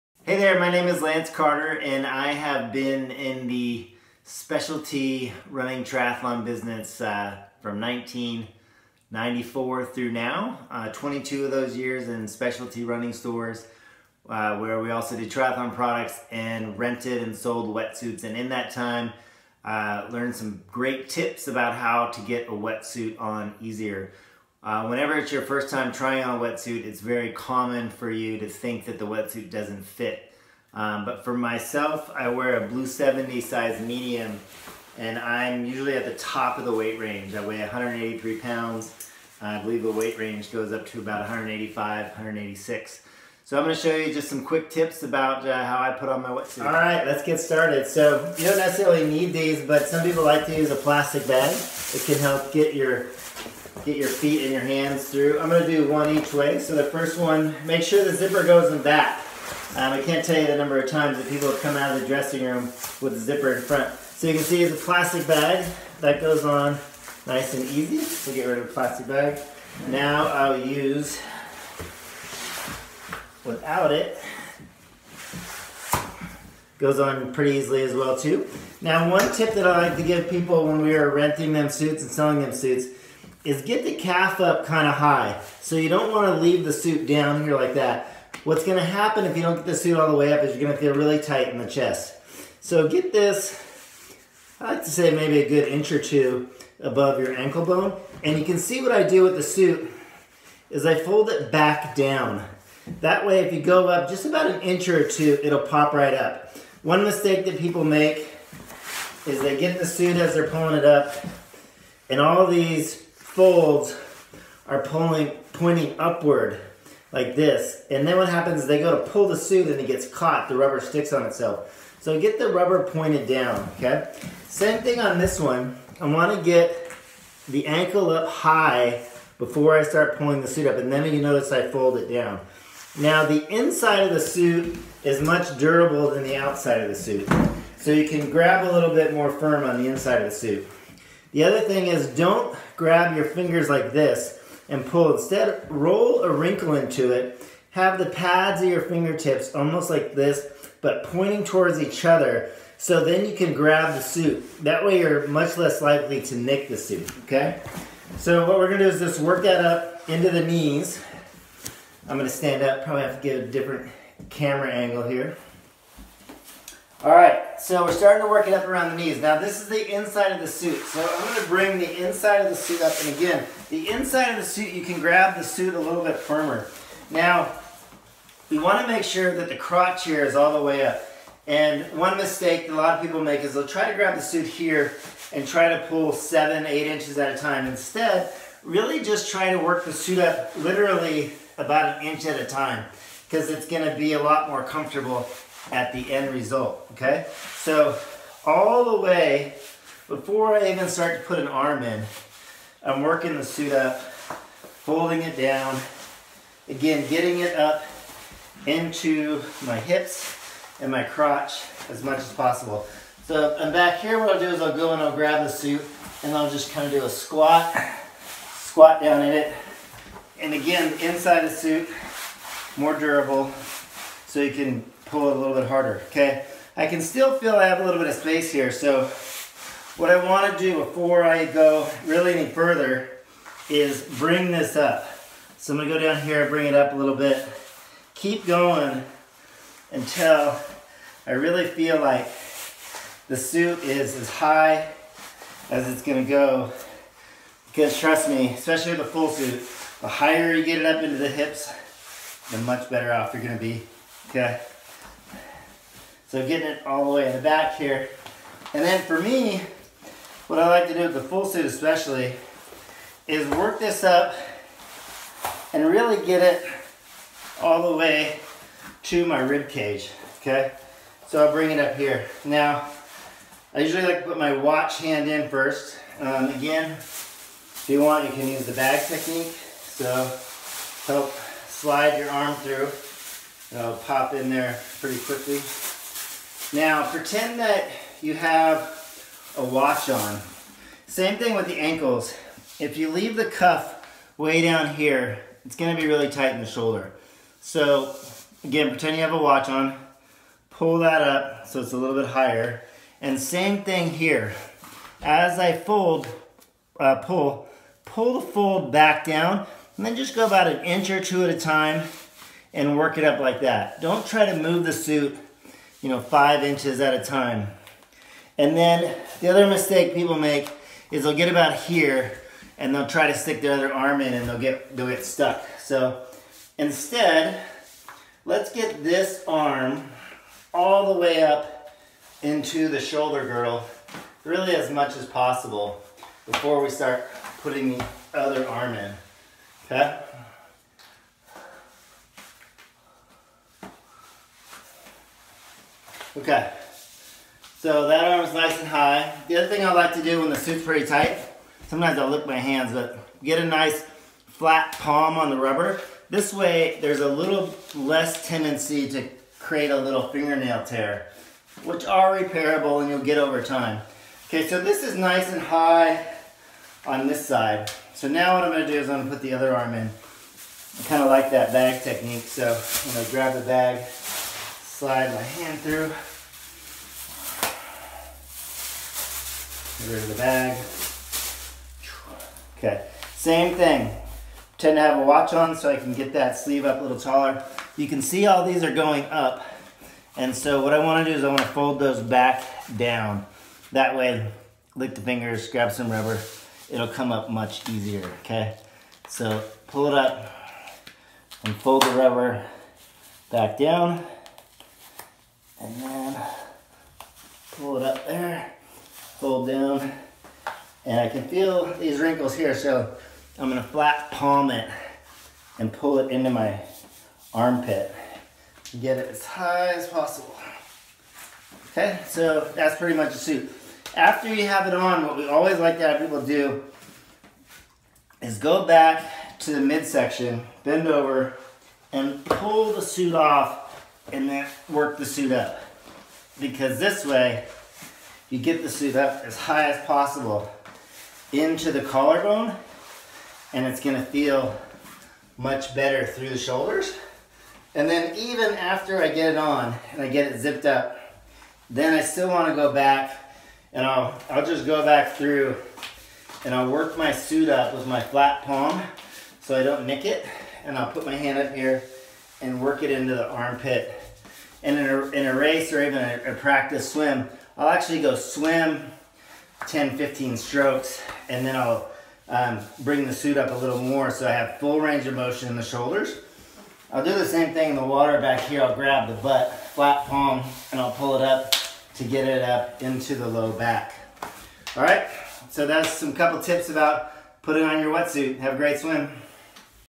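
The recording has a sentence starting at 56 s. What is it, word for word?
So the first one, make sure the zipper goes in back.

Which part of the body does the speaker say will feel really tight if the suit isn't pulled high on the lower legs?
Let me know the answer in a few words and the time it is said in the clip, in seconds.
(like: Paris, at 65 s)
Chest, at 91 s.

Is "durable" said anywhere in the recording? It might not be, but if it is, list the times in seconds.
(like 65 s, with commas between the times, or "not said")
135 s, 222 s.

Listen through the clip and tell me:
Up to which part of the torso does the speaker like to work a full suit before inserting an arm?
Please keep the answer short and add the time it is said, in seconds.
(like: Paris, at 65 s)
Rib cage, at 269 s.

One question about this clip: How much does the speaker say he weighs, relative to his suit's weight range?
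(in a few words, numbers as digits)
183 pounds.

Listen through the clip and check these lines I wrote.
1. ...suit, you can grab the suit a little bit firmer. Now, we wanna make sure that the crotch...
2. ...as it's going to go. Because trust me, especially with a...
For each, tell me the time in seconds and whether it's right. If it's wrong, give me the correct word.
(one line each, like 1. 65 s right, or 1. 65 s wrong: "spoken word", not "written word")
1. 174 s right
2. 245 s right.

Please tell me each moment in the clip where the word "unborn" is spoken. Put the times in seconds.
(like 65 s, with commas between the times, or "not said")
not said.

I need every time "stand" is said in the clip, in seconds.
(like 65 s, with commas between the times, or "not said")
162 s.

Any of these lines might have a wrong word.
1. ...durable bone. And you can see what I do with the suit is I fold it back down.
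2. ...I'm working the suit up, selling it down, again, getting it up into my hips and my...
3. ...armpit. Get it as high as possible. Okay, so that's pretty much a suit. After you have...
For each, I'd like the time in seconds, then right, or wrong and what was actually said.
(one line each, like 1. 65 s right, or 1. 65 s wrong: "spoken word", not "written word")
1. 97 s wrong: "ankle", not "durable"
2. 202 s wrong: "folding", not "selling"
3. 417 s right.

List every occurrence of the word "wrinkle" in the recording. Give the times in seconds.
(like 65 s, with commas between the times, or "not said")
146 s, 412 s.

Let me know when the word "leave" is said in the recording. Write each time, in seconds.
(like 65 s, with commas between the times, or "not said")
86 s, 293 s.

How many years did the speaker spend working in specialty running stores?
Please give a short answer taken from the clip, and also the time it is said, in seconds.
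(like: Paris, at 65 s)
22, at 10 s.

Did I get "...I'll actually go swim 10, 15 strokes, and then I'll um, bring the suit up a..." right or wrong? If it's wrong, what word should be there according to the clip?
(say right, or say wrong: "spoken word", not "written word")
right.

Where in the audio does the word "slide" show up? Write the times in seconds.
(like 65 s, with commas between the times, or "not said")
281 s, 375 s.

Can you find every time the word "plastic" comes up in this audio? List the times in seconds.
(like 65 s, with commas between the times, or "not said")
50 s, 64 s, 68 s.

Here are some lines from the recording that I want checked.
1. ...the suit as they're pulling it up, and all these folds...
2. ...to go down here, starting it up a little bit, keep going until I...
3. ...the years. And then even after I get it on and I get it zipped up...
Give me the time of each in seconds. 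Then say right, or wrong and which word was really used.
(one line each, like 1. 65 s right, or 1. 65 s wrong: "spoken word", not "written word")
1. 109 s right
2. 235 s wrong: "bring", not "starting"
3. 446 s wrong: "shoulders", not "years".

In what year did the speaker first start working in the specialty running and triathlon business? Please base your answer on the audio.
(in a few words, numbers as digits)
1994.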